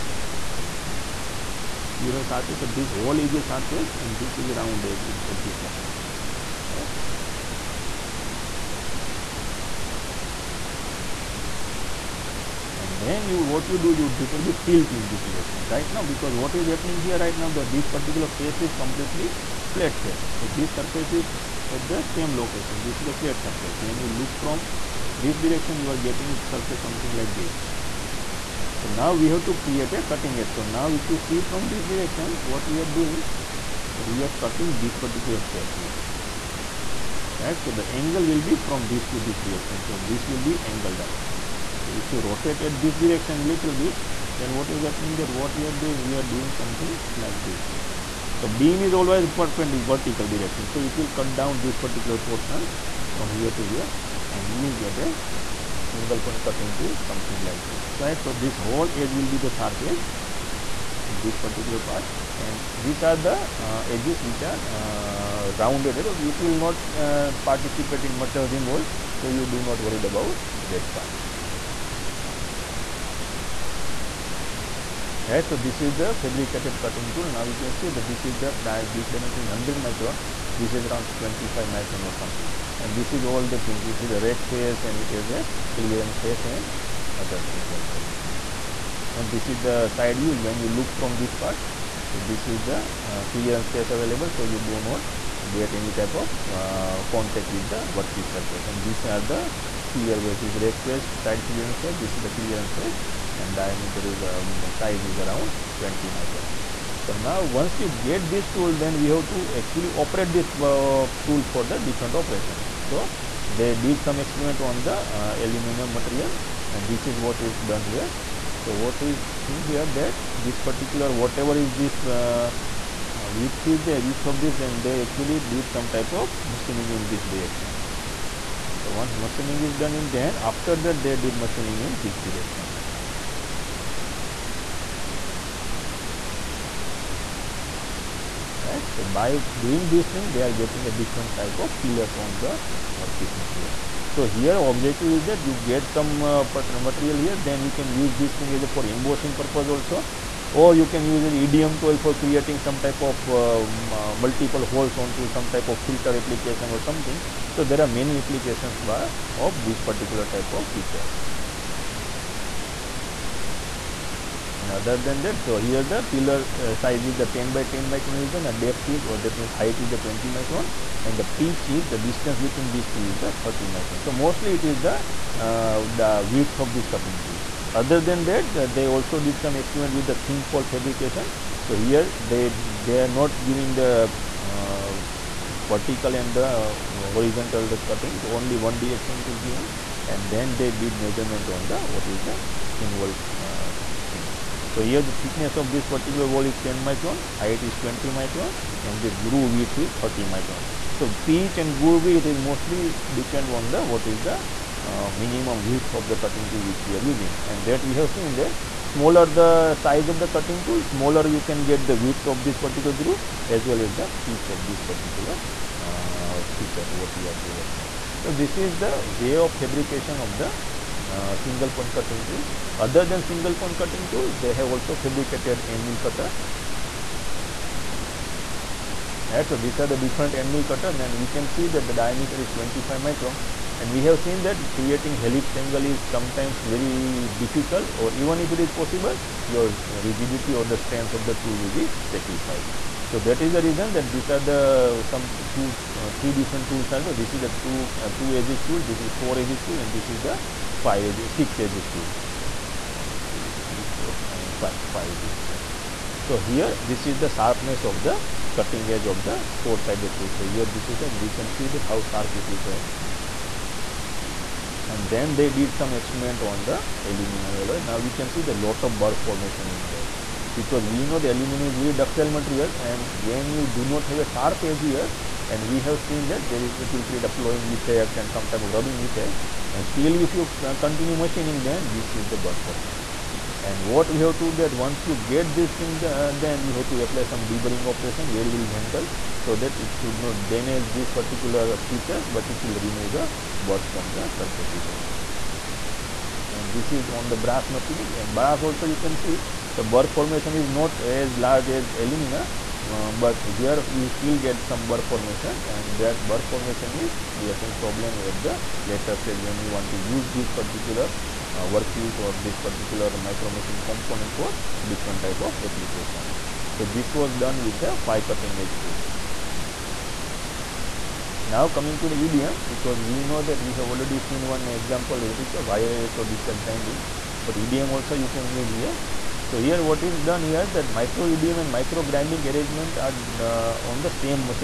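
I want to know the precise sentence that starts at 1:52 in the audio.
So, they did some experiment on the uh, aluminum material and this is what is done here.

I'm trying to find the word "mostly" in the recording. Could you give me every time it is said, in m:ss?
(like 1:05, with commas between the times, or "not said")
2:54, 3:22.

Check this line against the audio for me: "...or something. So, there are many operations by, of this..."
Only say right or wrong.
wrong.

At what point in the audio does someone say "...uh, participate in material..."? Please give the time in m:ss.
1:06.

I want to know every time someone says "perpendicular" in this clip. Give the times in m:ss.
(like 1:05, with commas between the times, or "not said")
0:49.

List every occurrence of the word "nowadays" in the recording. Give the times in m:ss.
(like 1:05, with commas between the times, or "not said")
not said.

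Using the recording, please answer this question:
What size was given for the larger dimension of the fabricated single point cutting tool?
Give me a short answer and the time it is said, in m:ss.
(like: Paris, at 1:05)
100 micron, at 1:19.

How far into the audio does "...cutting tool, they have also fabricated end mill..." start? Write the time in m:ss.
3:43.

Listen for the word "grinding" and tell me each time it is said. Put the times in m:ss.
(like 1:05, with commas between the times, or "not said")
5:26, 5:32.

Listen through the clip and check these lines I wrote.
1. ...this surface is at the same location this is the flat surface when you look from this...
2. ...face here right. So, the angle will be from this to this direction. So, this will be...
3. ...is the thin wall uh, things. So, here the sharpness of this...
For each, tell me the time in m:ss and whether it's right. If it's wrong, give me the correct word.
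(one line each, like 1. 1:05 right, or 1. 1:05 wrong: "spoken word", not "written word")
1. 0:20 right
2. 0:35 right
3. 3:12 wrong: "thickness", not "sharpness".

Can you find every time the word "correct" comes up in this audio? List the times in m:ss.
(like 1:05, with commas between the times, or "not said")
0:06.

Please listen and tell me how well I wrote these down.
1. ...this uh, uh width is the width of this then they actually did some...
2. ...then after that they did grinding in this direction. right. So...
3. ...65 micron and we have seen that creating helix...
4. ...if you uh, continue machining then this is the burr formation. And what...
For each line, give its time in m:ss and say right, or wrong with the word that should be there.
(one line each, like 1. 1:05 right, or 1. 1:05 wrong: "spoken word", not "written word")
1. 2:01 right
2. 2:10 wrong: "machining", not "grinding"
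3. 3:52 wrong: "25", not "65"
4. 4:40 right.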